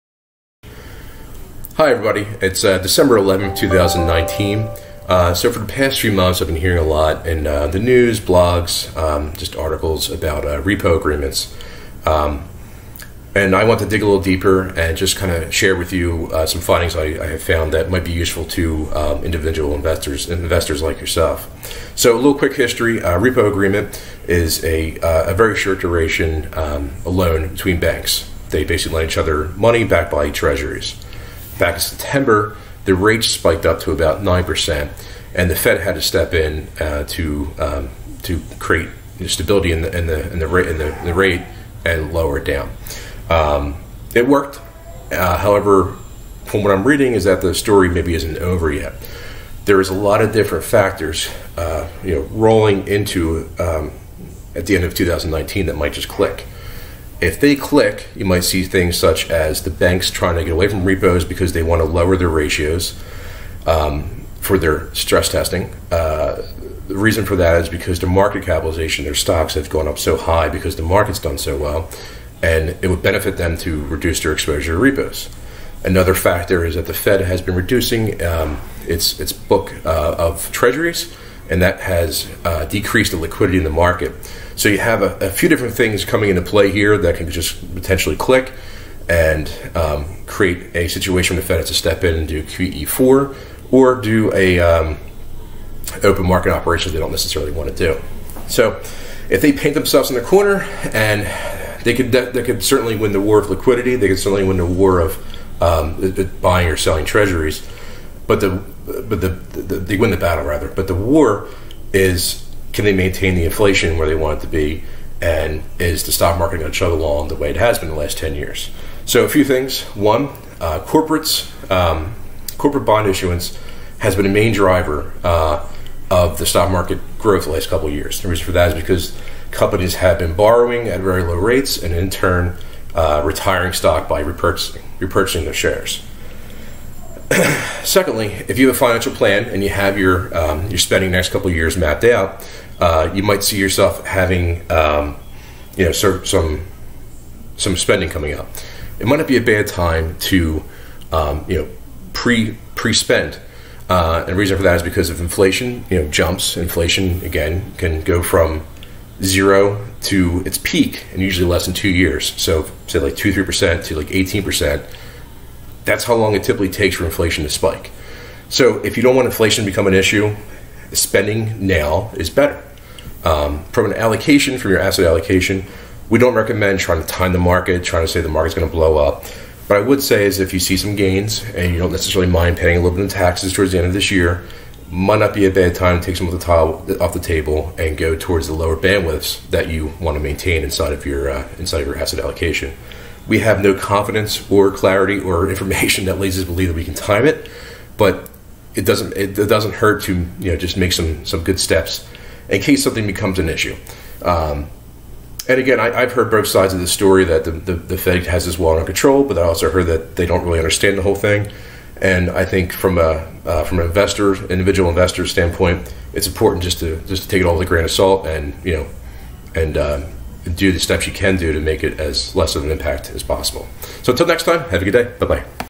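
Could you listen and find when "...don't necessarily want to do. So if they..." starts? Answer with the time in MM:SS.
01:36.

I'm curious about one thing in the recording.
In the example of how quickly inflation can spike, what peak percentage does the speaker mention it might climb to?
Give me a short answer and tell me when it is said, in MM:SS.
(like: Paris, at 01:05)
18%, at 02:44.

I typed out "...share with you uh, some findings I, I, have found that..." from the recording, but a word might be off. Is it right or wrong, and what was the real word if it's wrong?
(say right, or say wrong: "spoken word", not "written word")
right.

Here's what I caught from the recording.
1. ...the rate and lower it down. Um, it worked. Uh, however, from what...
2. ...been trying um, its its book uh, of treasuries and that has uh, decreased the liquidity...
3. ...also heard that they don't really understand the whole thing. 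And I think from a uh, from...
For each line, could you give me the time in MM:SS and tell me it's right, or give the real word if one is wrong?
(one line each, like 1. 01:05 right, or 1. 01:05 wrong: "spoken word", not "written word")
1. 00:41 right
2. 01:17 wrong: "reducing", not "trying"
3. 03:29 right.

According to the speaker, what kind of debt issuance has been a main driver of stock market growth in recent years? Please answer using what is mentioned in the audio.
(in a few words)
corporate bond issuance.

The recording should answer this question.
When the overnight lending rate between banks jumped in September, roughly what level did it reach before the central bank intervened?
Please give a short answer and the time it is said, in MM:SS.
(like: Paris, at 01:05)
9%, at 00:34.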